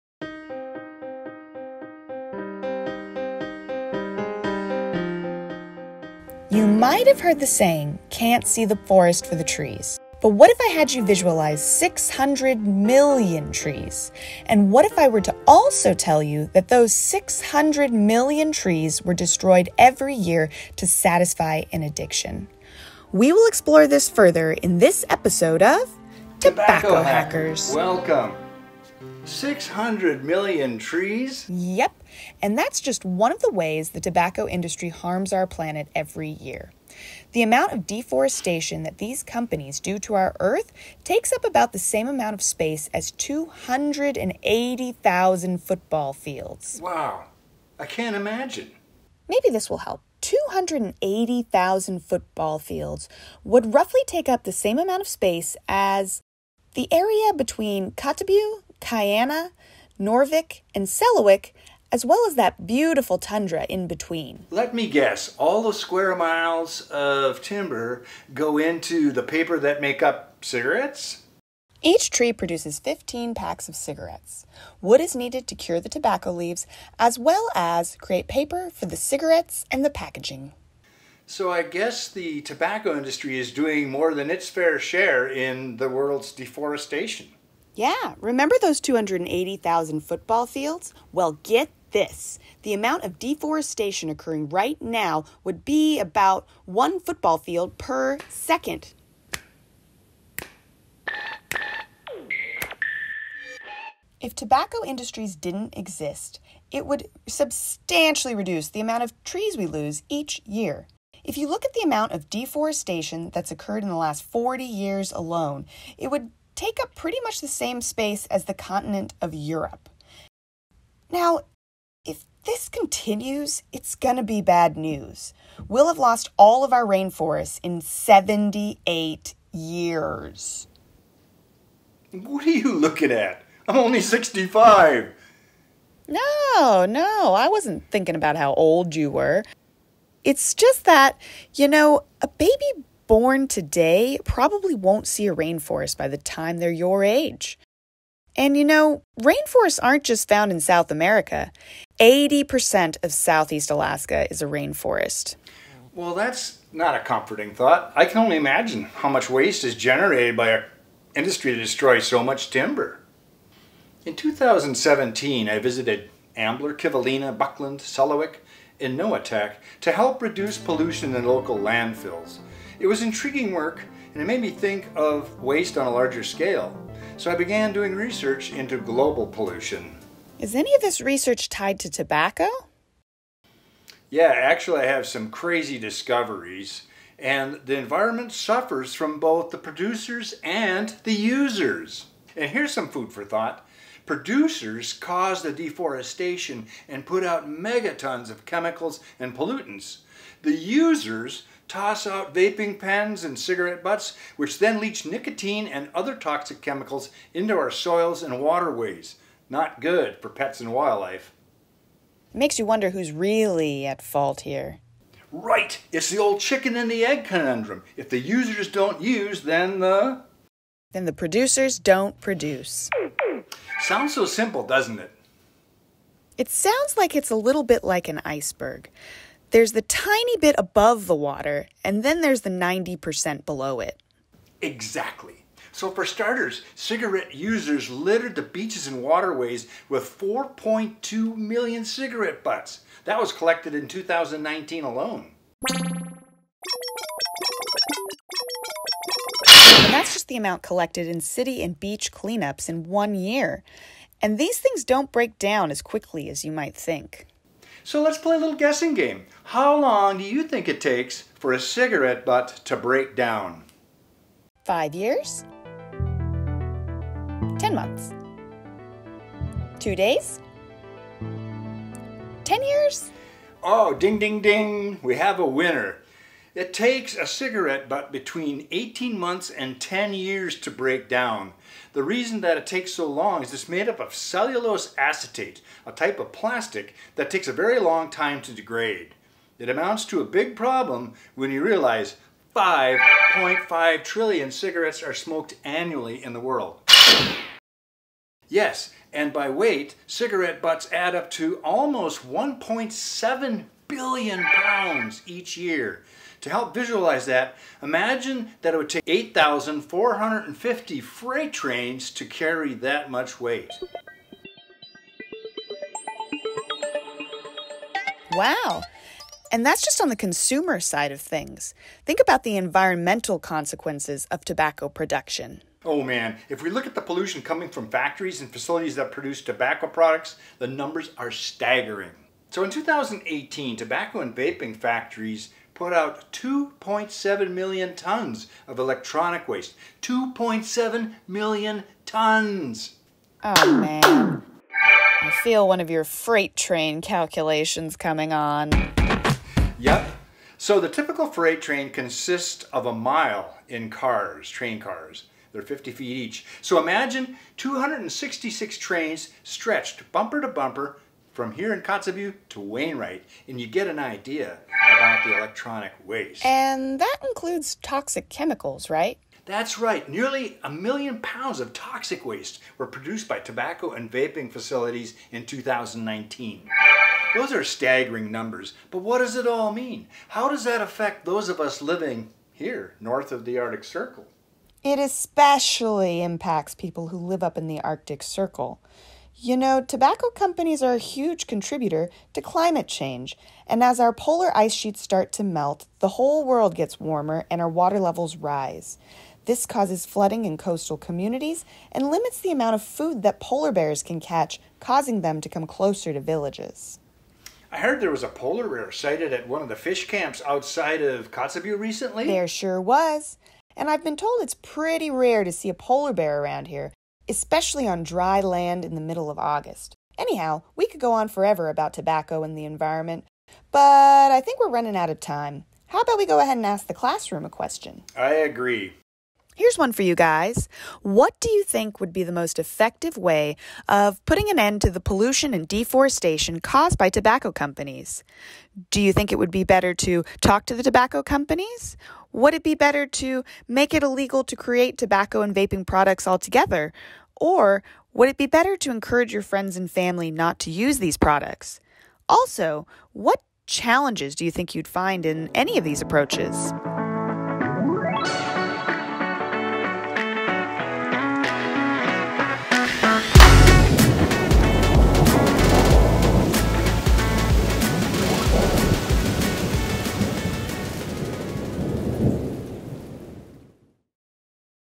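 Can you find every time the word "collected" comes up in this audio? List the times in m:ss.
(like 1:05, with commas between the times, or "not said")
4:03, 4:10.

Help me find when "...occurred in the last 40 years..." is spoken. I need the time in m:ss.
1:53.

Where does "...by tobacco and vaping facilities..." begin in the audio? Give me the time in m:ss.
6:13.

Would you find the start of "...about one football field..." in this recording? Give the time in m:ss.
1:35.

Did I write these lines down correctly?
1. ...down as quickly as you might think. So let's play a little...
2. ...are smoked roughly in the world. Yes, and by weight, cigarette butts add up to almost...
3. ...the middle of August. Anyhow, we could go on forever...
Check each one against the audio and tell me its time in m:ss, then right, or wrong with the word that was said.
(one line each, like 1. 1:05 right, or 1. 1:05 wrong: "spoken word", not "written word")
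1. 4:15 right
2. 4:55 wrong: "annually", not "roughly"
3. 6:58 right.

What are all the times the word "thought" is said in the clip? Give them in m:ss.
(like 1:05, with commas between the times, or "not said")
2:37, 3:13.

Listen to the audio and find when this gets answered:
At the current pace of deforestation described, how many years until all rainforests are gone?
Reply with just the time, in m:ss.
2:07.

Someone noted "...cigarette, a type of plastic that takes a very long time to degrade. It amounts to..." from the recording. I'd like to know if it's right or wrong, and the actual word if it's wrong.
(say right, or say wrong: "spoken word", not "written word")
wrong: "acetate", not "cigarette".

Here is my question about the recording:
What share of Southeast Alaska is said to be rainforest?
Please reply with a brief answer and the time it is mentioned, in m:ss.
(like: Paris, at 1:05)
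80%, at 2:31.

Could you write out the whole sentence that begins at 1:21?
So I guess the tobacco industry is doing more than its fair share in the world's deforestation.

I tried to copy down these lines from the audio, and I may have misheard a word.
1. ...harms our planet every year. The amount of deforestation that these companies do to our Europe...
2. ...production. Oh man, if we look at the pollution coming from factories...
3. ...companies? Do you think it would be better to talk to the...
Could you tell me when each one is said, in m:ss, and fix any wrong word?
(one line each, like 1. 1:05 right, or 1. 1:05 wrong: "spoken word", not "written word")
1. 0:34 wrong: "Earth", not "Europe"
2. 5:24 right
3. 7:17 right.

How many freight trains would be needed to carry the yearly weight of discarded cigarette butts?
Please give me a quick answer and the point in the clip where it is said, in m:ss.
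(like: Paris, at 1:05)
8,450, at 5:09.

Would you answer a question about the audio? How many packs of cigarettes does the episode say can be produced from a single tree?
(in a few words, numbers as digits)
15.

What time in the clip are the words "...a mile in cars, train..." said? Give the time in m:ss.
5:52.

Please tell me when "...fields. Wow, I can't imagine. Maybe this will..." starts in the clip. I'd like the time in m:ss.
0:46.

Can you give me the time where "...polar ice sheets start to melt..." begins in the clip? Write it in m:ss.
6:34.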